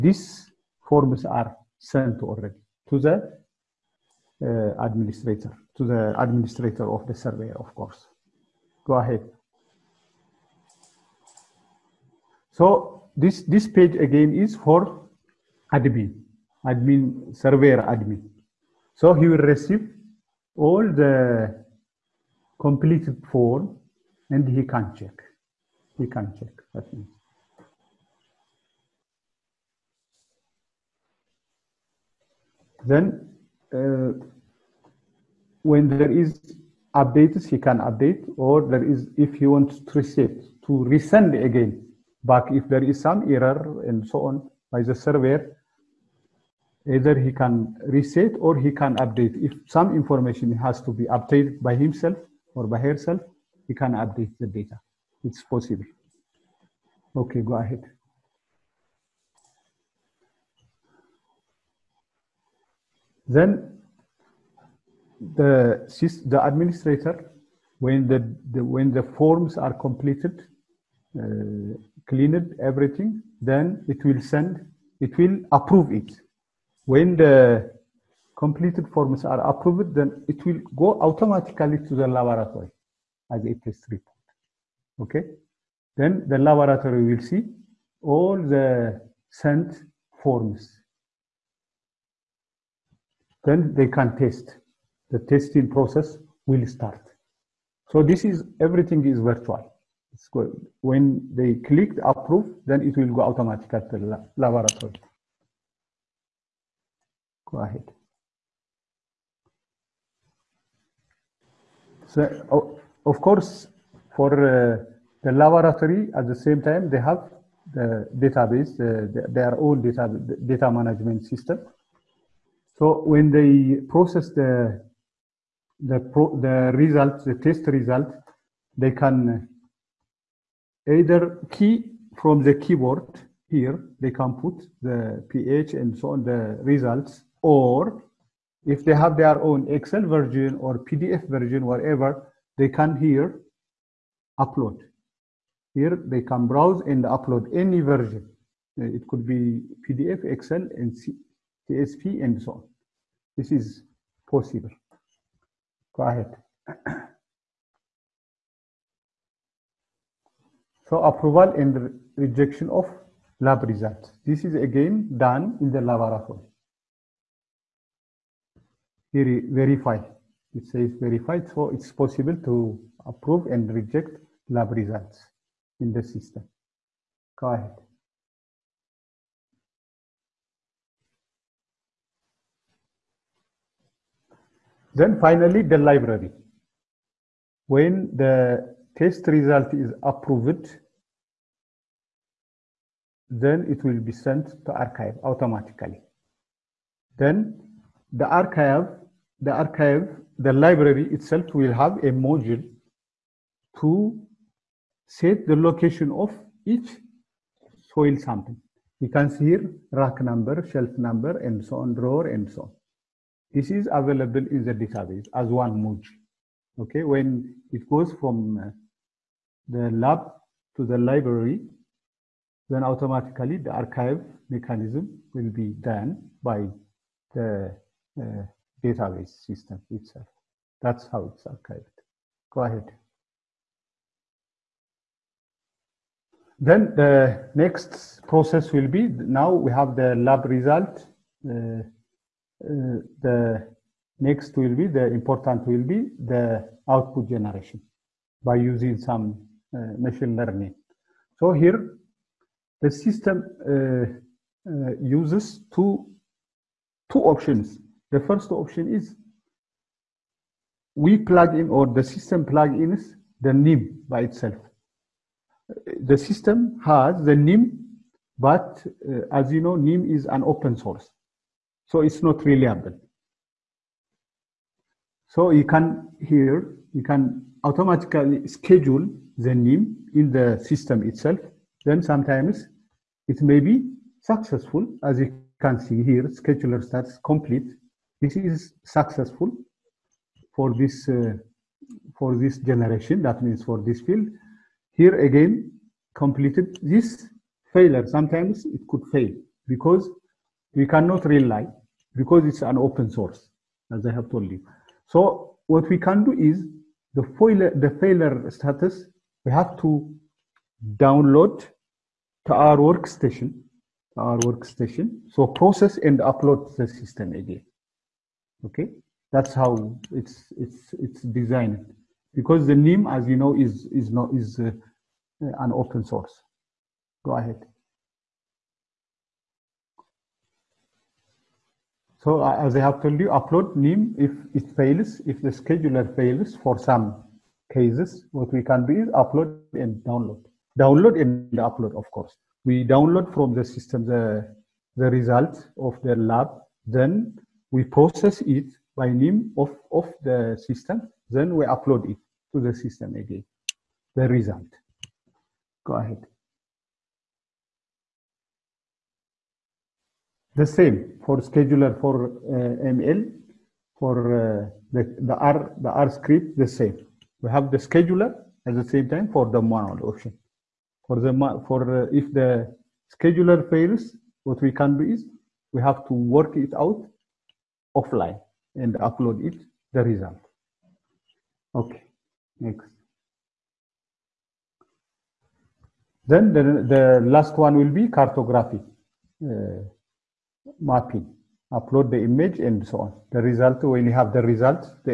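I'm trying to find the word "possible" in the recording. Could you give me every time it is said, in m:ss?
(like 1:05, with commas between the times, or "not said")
0:55, 2:34, 2:51.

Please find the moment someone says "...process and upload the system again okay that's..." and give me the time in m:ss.
5:15.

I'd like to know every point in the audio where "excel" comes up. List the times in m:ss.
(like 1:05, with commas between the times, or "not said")
2:19, 2:30.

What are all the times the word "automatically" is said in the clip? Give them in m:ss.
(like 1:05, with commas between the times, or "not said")
1:21, 1:43, 3:15, 3:42, 4:37.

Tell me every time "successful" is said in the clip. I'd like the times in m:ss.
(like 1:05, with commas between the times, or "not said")
4:44, 4:48.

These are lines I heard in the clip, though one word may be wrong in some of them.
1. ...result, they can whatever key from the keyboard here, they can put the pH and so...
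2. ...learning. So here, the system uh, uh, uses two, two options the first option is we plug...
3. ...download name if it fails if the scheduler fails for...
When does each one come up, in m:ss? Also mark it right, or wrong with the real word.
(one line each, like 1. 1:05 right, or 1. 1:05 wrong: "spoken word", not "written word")
1. 2:07 wrong: "either", not "whatever"
2. 4:10 right
3. 5:33 wrong: "upload", not "download".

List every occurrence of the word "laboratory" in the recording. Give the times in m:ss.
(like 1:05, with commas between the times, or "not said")
1:22, 1:26, 1:44, 1:55, 2:45.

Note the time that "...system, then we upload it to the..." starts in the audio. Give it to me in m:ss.
5:50.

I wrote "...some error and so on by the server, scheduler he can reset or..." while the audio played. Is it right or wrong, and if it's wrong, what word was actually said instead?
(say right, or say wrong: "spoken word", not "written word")
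wrong: "either", not "scheduler".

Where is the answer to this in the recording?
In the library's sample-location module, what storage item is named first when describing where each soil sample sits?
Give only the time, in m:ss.
3:29.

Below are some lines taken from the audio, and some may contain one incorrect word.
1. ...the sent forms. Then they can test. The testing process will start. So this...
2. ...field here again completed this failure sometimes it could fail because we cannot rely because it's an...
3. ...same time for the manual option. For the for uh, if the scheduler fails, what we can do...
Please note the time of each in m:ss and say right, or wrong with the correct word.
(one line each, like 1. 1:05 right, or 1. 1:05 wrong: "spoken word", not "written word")
1. 1:28 right
2. 4:54 right
3. 6:08 right.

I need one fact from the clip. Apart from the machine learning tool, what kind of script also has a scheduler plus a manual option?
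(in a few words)
R script.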